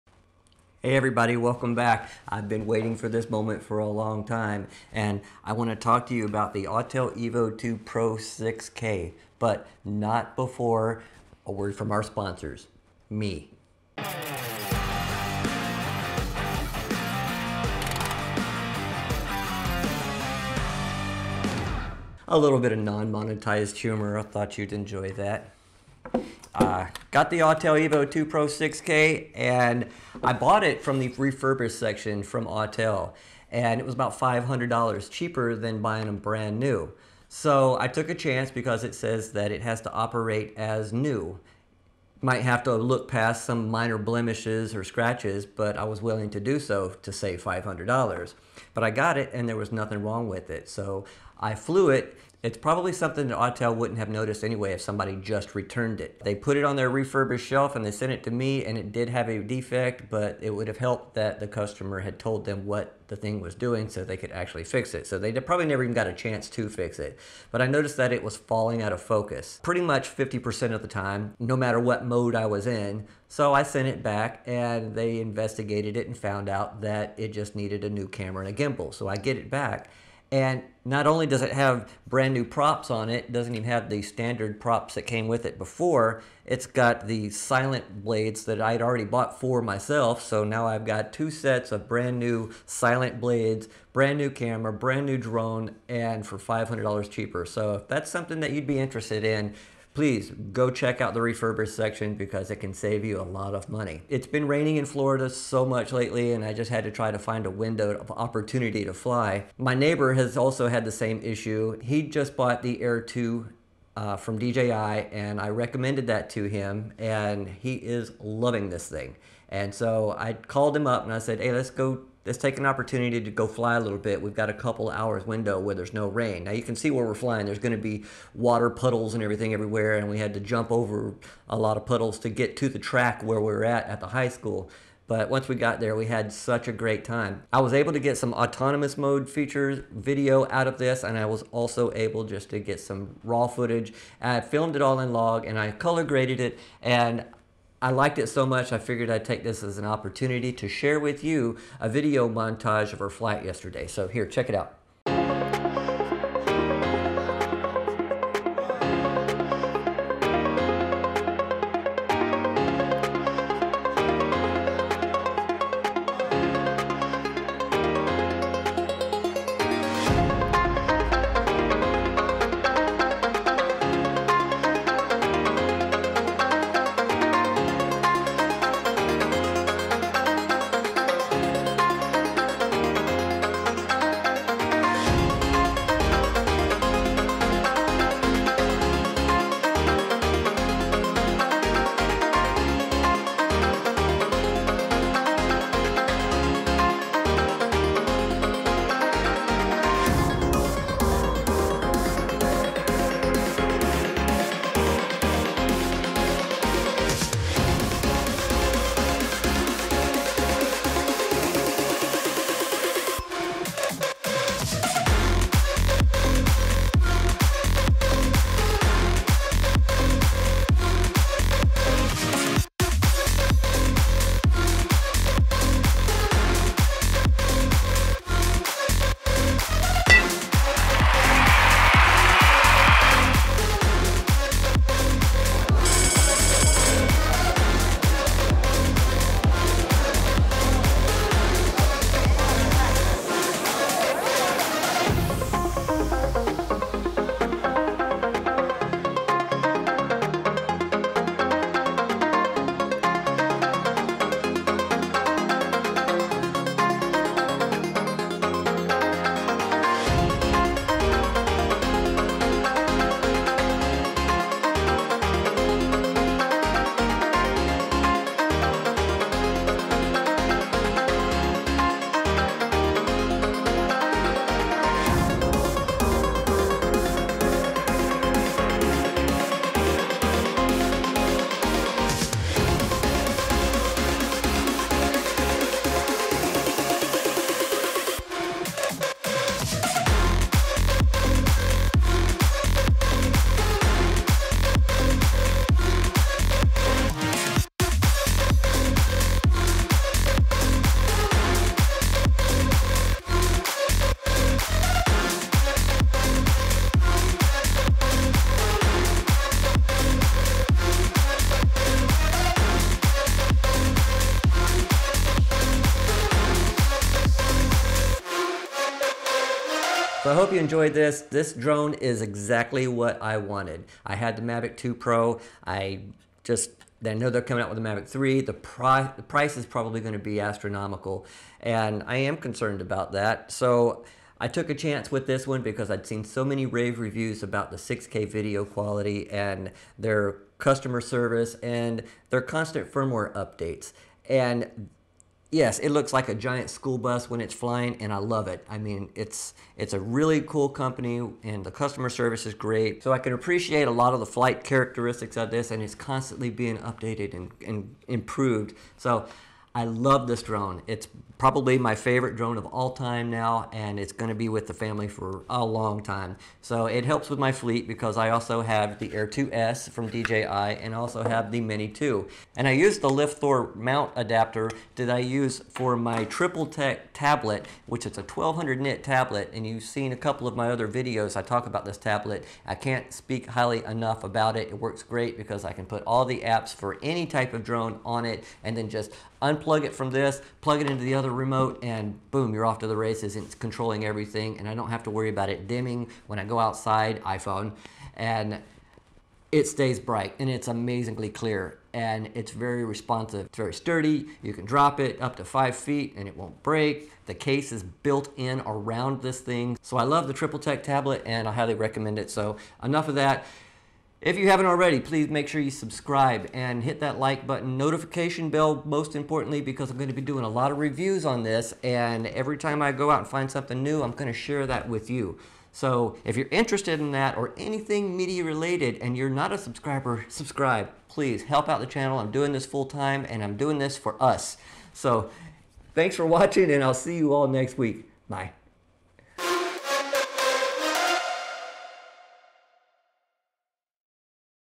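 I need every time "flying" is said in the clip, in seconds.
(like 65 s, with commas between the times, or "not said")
127 s, 347 s.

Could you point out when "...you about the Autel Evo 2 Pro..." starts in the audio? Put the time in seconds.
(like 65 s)
6 s.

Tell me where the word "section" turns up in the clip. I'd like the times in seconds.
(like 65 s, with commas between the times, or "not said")
31 s, 101 s.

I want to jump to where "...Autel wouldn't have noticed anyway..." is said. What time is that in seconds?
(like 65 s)
53 s.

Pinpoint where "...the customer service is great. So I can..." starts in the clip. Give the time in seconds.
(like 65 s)
351 s.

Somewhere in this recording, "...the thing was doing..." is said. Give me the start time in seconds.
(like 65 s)
63 s.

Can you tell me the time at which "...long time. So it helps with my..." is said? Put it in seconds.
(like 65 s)
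365 s.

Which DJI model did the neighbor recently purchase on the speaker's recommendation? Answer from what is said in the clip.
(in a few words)
Air 2.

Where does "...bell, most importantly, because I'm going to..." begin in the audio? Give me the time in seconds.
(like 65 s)
418 s.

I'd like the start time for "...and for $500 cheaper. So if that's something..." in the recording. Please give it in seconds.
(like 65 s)
95 s.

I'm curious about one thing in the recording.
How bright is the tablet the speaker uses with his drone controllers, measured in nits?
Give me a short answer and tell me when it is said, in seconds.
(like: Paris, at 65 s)
1200 nit, at 378 s.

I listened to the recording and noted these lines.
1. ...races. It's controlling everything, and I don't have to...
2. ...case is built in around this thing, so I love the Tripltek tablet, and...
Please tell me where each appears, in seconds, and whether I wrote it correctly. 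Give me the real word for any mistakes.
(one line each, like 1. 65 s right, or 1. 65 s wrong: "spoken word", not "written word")
1. 392 s right
2. 407 s right.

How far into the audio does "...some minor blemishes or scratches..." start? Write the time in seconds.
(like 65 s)
43 s.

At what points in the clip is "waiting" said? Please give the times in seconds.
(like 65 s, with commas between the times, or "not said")
2 s.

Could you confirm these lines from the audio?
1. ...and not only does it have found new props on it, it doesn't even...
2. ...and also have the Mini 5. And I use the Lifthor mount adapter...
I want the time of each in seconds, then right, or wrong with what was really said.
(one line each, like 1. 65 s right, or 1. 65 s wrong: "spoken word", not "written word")
1. 80 s wrong: "brand", not "found"
2. 370 s wrong: "2", not "5".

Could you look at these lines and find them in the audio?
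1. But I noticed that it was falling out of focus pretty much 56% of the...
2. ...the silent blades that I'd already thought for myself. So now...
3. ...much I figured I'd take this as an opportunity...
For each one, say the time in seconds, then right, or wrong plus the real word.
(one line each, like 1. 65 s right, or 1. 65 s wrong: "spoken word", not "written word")
1. 67 s wrong: "50", not "56"
2. 87 s wrong: "bought", not "thought"
3. 148 s right.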